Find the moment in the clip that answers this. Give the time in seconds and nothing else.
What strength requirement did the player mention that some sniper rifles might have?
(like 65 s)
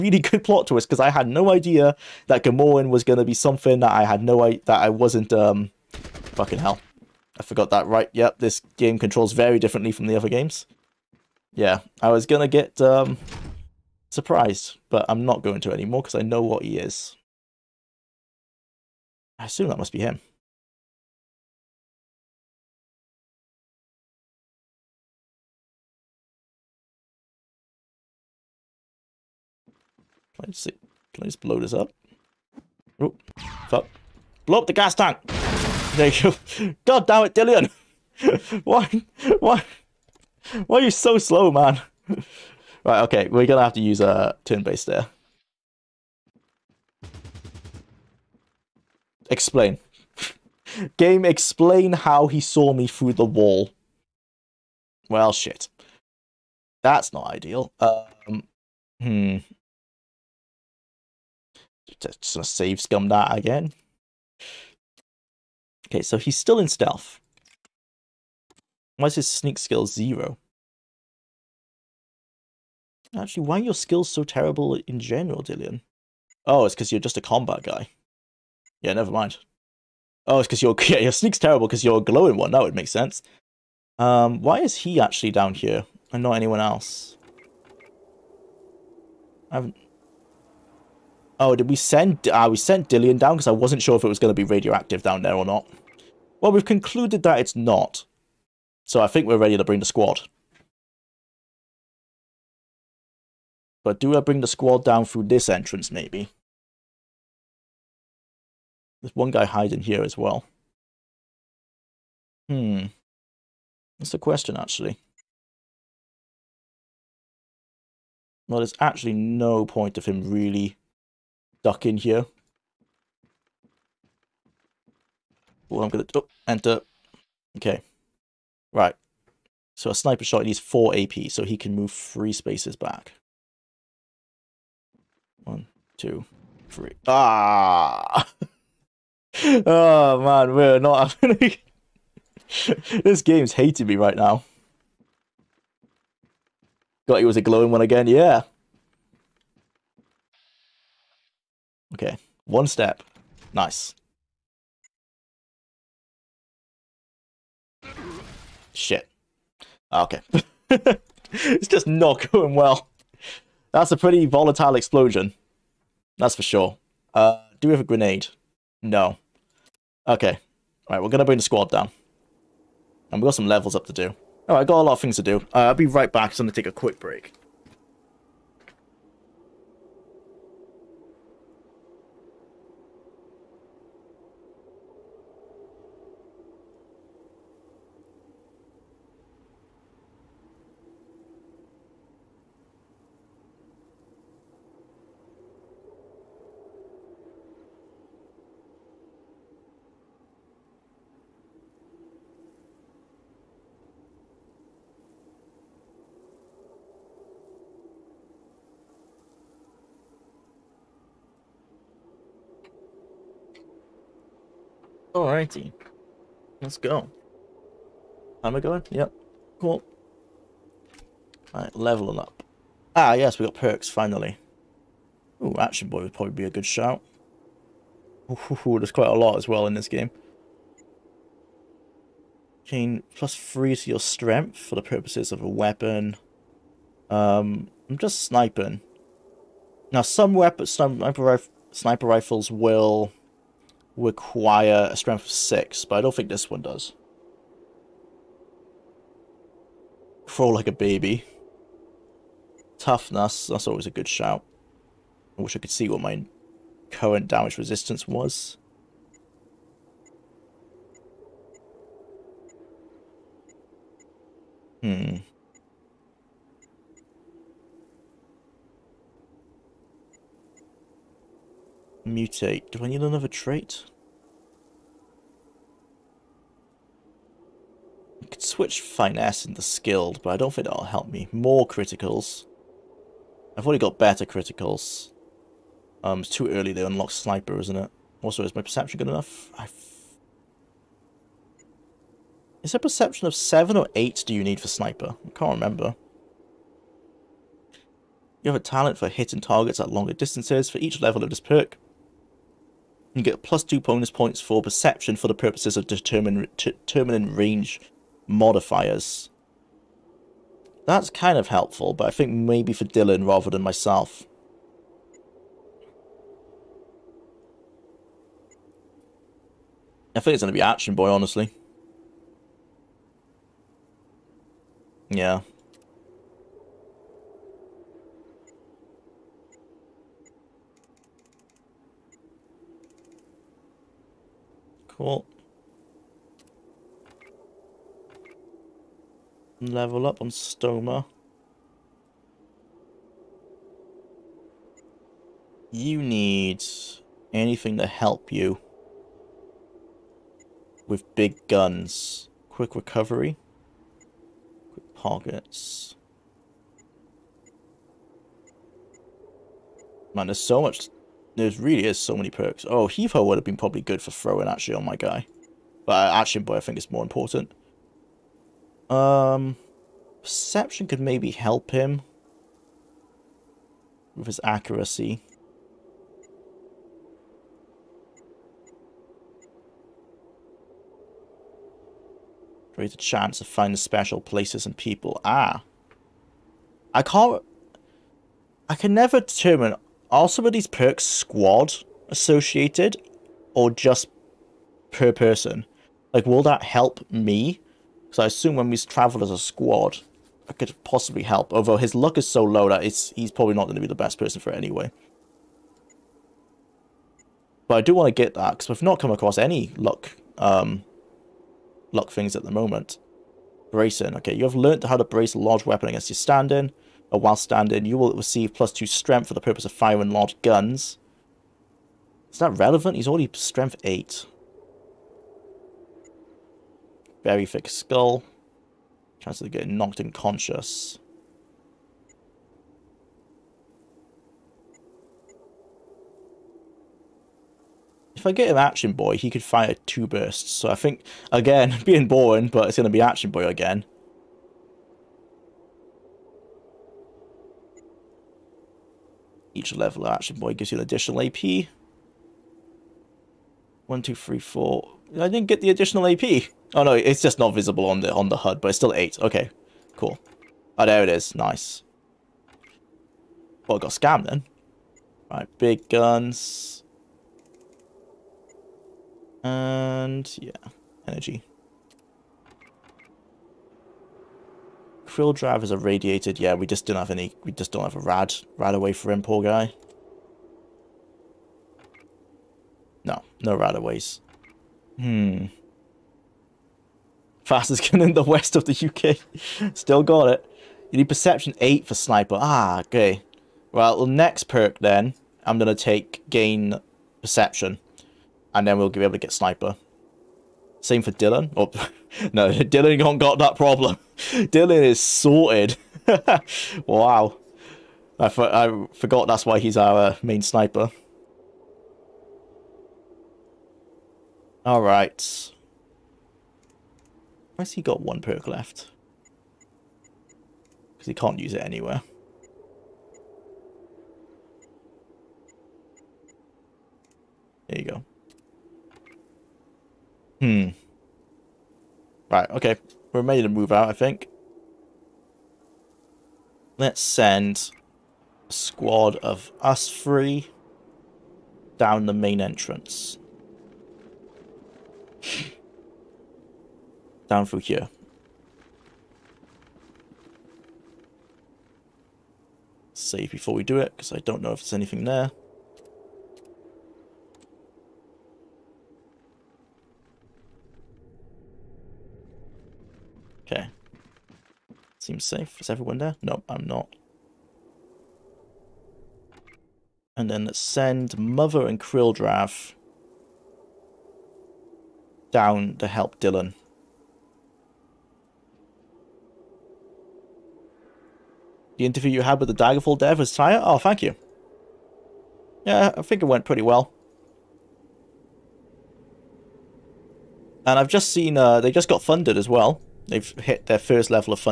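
245 s.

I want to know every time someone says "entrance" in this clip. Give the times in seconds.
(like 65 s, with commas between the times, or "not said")
105 s, 542 s.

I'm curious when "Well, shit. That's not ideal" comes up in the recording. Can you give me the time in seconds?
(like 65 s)
55 s.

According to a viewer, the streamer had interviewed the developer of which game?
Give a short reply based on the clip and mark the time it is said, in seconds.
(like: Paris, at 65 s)
Daggerfall, at 582 s.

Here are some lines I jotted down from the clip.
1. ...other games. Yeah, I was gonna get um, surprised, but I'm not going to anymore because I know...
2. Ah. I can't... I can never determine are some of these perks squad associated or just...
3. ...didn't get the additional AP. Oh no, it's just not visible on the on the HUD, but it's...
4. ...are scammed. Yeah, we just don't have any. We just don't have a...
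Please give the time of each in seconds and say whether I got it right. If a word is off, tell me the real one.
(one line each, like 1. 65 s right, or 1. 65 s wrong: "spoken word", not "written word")
1. 10 s right
2. 385 s right
3. 455 s right
4. 475 s wrong: "radiated", not "scammed".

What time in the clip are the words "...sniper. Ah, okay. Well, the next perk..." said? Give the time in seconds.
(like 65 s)
491 s.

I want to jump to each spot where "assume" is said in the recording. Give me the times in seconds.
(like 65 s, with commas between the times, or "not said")
19 s, 398 s.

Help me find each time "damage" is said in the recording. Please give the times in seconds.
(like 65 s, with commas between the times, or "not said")
257 s.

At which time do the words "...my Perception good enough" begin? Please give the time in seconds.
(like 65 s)
288 s.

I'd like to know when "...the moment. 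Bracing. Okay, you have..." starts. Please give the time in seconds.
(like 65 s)
412 s.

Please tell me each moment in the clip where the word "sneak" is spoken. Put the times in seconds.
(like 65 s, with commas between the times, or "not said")
69 s, 81 s.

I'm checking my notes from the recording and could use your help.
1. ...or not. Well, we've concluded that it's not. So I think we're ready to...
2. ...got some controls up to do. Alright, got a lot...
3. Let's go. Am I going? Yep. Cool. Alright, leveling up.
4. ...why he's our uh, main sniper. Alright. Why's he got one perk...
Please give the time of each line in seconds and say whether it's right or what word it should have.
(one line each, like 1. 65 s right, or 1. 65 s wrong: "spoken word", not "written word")
1. 95 s right
2. 173 s wrong: "levels", not "controls"
3. 216 s right
4. 509 s right.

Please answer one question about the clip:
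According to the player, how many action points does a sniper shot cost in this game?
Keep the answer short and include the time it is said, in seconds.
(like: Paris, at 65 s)
4, at 130 s.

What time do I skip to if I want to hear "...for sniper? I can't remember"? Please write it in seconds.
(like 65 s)
294 s.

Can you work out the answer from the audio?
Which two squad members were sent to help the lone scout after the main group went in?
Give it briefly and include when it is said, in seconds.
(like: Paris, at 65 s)
Mother and Krilldrav, at 571 s.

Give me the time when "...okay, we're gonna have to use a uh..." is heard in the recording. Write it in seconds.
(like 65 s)
43 s.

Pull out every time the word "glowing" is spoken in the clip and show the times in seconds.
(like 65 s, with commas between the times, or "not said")
82 s, 147 s.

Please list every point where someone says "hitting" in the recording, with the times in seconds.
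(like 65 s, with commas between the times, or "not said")
299 s.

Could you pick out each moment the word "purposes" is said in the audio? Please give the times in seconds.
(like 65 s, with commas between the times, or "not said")
234 s, 305 s, 419 s.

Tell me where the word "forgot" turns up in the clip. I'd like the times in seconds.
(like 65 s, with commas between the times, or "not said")
7 s, 508 s.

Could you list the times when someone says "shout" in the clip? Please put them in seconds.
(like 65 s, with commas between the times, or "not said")
226 s, 254 s.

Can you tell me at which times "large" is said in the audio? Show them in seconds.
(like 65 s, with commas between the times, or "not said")
415 s, 420 s.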